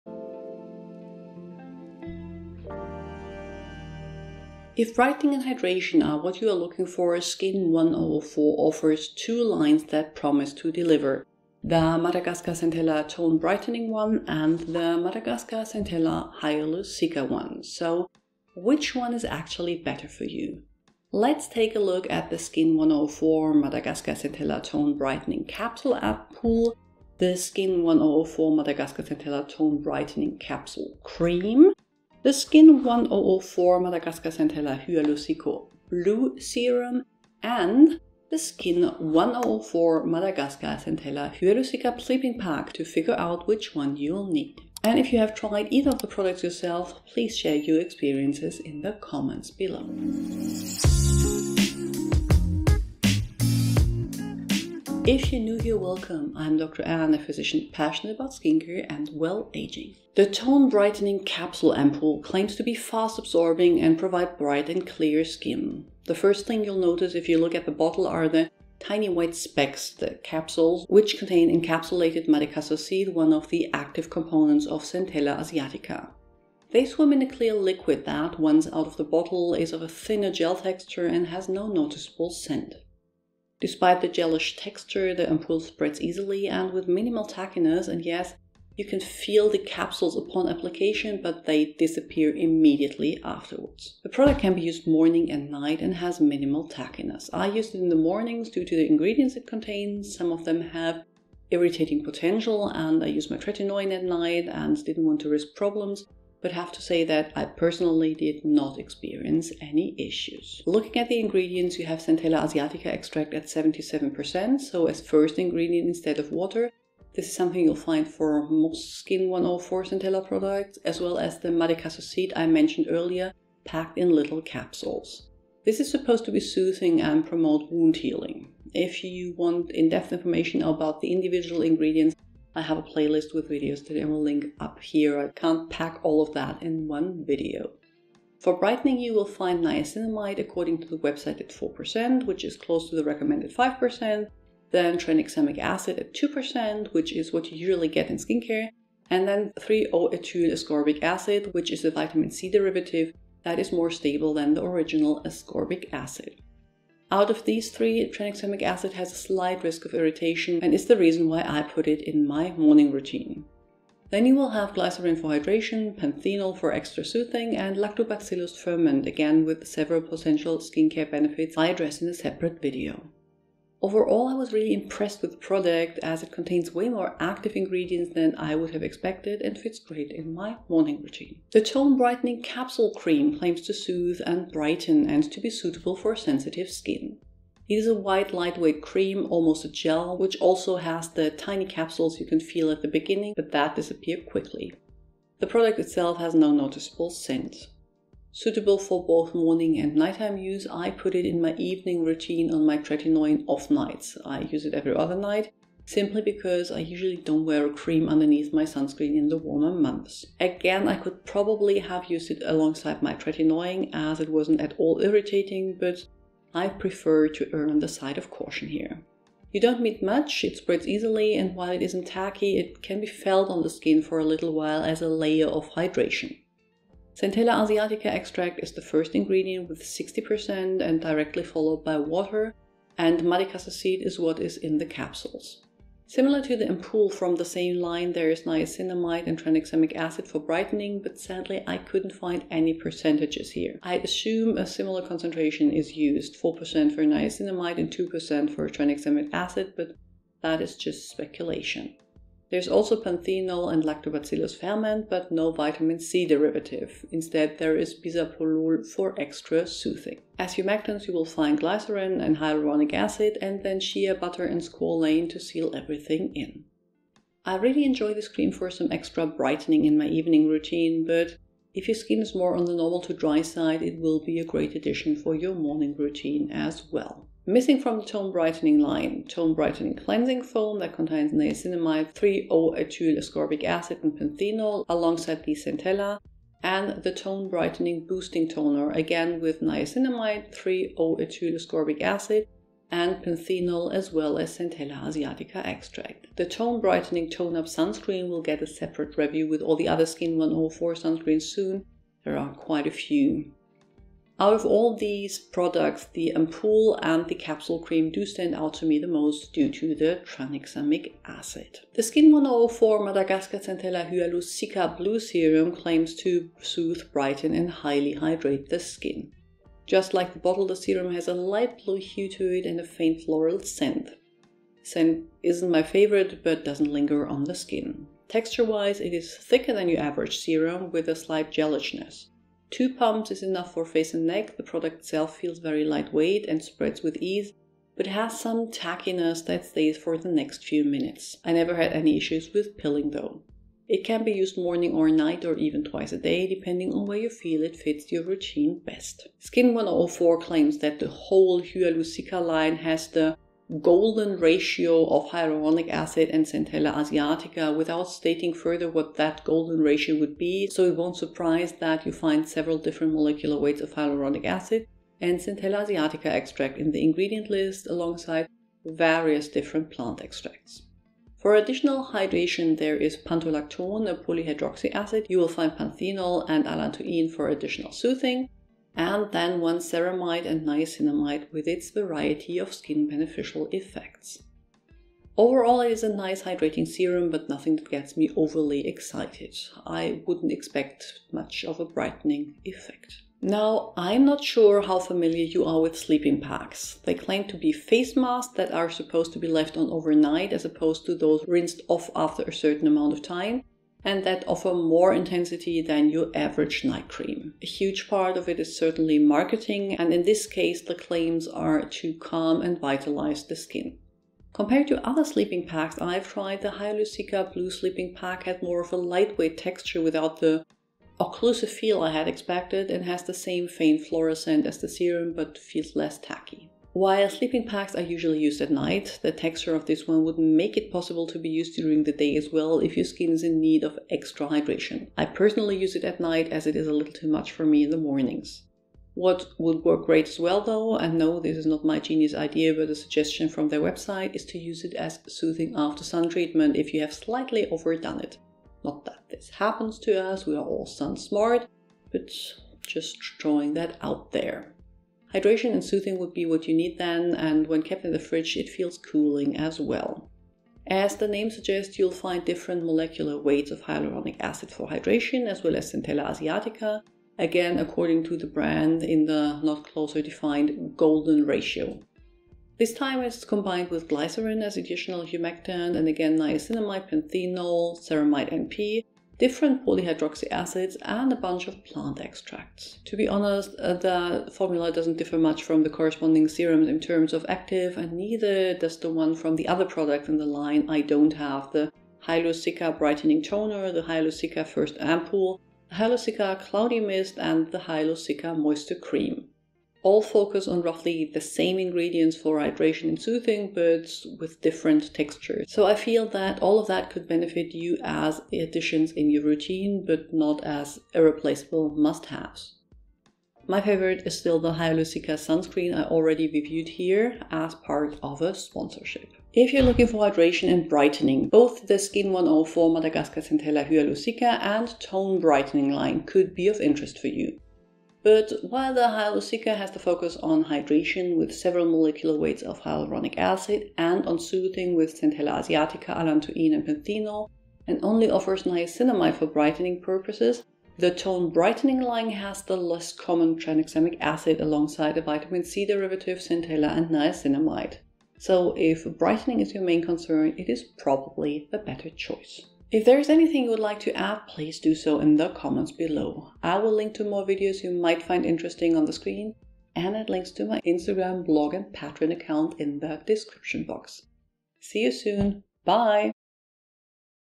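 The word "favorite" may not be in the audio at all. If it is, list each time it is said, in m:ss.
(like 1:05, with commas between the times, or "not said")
5:25, 8:33.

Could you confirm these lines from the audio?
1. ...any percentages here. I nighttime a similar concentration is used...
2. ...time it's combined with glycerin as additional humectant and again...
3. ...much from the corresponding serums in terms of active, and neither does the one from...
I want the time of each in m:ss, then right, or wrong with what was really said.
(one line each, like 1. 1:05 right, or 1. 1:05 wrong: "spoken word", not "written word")
1. 4:02 wrong: "assume", not "nighttime"
2. 7:52 right
3. 8:05 right.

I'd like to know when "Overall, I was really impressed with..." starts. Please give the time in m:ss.
2:53.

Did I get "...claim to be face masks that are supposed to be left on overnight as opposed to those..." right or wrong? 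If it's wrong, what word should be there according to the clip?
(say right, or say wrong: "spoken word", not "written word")
right.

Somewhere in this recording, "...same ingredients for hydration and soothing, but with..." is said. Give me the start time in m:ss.
8:21.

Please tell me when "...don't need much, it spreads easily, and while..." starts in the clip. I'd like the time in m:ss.
3:39.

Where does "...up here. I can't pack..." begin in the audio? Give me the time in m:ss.
2:14.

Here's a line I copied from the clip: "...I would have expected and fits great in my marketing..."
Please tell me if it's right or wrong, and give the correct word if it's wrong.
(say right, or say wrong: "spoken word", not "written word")
wrong: "morning", not "marketing".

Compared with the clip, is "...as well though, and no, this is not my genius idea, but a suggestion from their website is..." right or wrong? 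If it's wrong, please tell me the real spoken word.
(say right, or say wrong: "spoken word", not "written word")
right.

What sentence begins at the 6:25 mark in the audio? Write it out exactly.
Overall, it is a nice hydrating serum, but nothing that gets me overly excited.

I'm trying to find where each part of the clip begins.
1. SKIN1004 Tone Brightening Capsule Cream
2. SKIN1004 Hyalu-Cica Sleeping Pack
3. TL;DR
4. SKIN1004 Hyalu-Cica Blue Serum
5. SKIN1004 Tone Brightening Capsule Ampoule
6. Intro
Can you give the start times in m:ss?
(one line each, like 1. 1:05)
1. 3:01
2. 6:33
3. 8:40
4. 5:11
5. 1:00
6. 0:50.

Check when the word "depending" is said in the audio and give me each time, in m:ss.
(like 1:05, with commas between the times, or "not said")
5:46.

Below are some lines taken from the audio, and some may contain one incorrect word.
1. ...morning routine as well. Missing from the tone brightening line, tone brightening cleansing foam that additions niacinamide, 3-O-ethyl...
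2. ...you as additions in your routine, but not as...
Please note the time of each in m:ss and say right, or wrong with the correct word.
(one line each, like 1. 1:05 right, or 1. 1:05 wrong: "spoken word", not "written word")
1. 4:35 wrong: "contains", not "additions"
2. 8:27 right.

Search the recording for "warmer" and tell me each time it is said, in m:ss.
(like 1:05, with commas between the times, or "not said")
3:29.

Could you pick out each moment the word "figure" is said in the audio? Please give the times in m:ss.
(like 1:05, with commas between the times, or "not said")
0:42.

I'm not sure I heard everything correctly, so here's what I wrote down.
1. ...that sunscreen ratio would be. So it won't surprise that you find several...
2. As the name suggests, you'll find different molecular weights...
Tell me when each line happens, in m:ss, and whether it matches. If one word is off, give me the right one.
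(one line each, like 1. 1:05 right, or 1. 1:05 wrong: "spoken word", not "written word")
1. 5:59 wrong: "golden", not "sunscreen"
2. 7:40 right.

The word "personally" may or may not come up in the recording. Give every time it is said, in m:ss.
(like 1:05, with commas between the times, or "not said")
1:47, 7:15.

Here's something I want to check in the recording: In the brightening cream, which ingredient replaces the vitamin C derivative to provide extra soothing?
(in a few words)
bisabolol.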